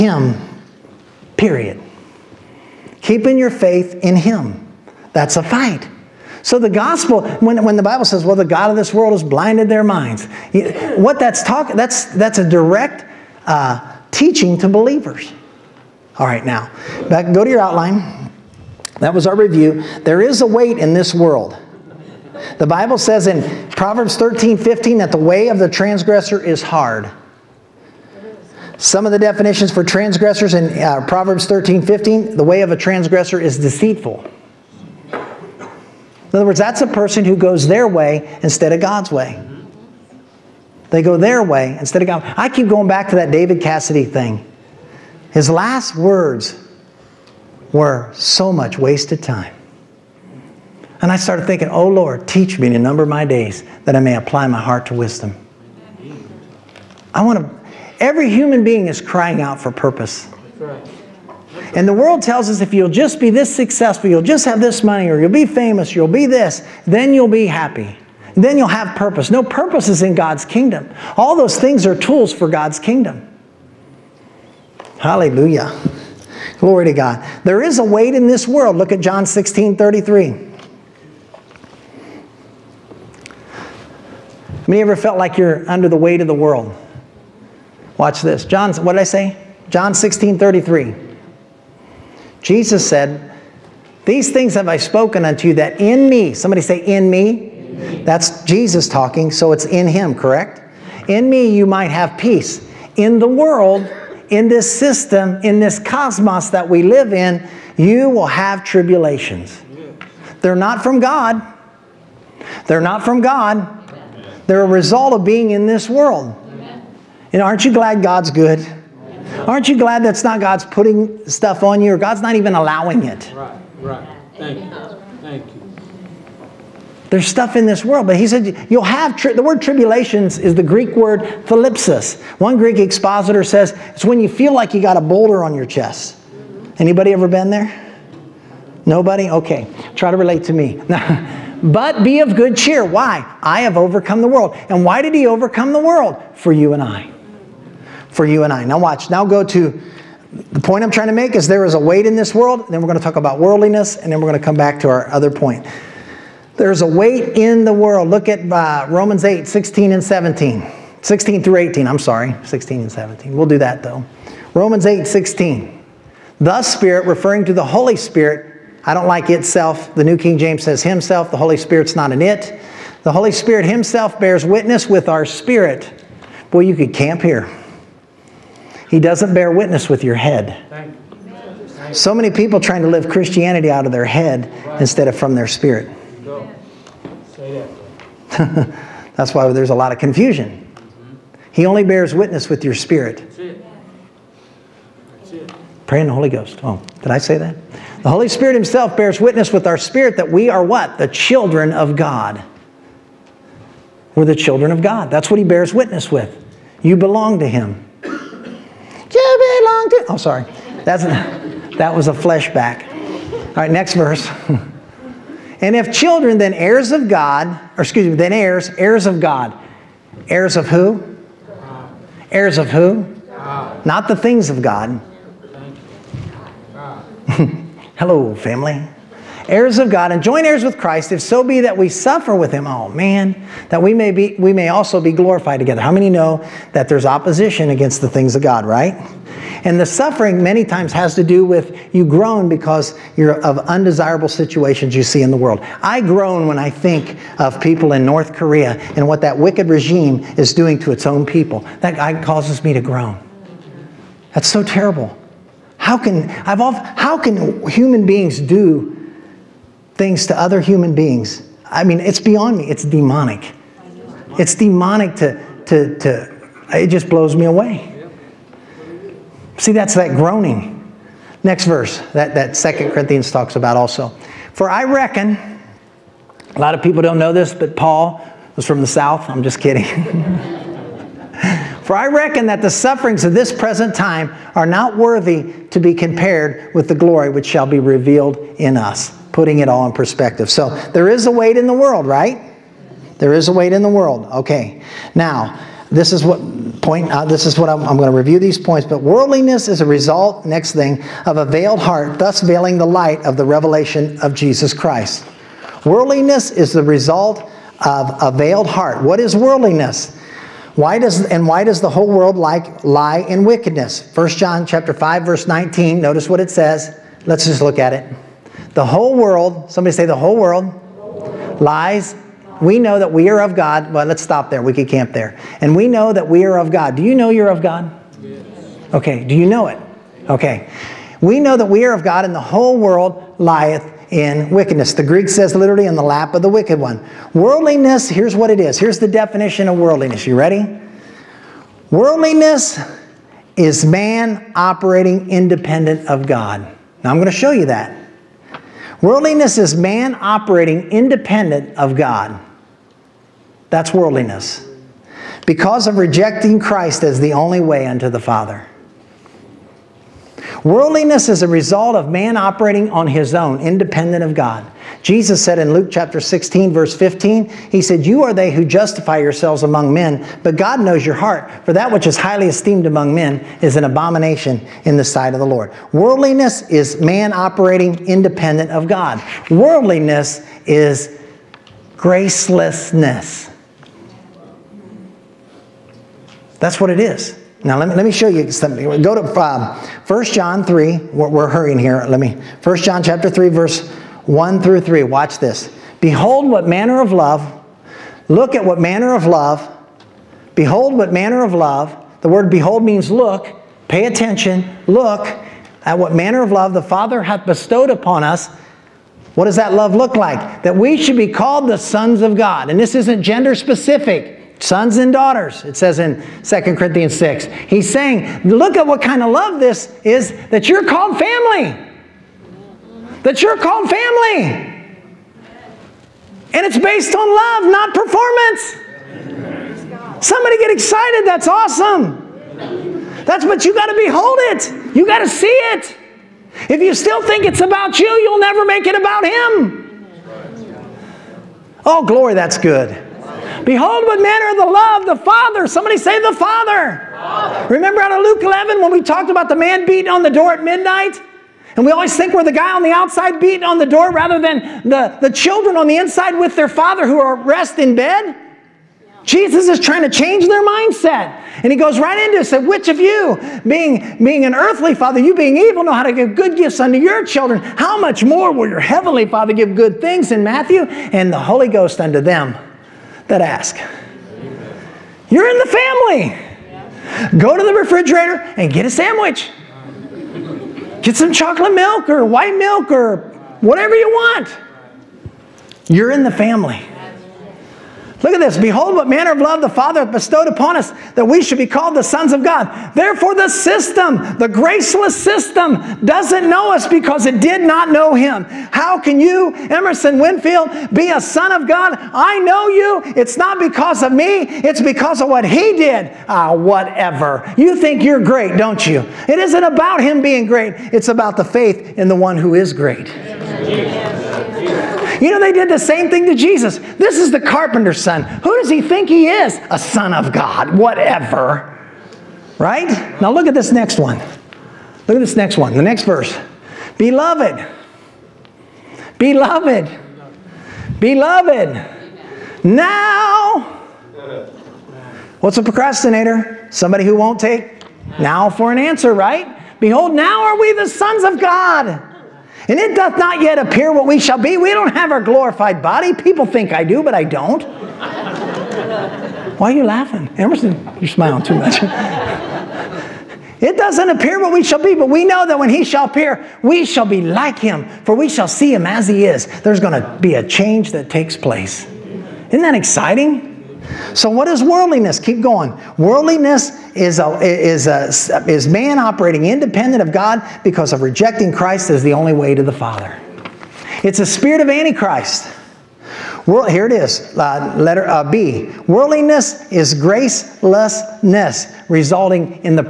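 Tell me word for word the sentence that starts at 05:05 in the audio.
Worldliness is the result of a veiled heart.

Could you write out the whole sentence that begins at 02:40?
16 through 18, I'm sorry, 16 and 17.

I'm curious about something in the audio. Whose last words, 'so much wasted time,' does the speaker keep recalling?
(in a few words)
David Cassidy.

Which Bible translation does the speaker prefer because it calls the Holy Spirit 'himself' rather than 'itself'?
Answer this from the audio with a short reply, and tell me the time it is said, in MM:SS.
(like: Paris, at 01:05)
New King James, at 02:49.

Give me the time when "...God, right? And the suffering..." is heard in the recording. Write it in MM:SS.
03:58.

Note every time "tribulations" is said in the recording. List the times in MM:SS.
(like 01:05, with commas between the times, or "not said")
01:48, 02:09.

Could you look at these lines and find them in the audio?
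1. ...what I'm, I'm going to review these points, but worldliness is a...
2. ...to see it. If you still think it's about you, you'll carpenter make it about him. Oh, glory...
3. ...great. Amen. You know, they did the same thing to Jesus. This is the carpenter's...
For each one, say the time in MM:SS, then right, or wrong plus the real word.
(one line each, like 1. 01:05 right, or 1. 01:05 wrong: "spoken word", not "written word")
1. 04:57 right
2. 07:15 wrong: "never", not "carpenter"
3. 08:32 right.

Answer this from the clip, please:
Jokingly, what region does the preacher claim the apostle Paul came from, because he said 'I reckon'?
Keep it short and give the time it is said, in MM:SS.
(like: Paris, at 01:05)
the South, at 04:38.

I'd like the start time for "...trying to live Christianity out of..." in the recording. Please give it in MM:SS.
03:02.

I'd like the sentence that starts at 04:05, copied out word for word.
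I groan when I think of people in North Korea and what that wicked regime is doing to its own people.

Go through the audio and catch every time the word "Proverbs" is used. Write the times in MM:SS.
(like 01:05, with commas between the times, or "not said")
00:23, 00:31.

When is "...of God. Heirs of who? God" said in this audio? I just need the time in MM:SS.
03:39.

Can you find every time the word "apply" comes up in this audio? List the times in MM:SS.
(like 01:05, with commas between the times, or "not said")
00:54.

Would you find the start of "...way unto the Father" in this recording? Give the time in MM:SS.
05:57.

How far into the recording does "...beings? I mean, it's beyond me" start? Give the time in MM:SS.
04:20.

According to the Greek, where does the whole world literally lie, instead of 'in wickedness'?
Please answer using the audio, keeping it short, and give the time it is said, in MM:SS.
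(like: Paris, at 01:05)
in the lap of the wicked one, at 05:35.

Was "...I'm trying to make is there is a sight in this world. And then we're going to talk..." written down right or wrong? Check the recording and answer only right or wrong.
wrong.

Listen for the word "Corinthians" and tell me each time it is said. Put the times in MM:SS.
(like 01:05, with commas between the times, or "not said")
04:32, 06:56.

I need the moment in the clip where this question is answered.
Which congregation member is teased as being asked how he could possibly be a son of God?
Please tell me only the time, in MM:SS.
08:19.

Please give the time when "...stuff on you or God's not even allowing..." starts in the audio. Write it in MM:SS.
02:01.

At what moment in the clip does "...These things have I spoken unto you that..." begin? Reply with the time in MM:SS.
01:34.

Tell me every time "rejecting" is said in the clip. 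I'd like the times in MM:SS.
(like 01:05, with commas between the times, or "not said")
05:55, 09:31.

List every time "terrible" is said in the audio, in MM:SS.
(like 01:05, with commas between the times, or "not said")
04:14.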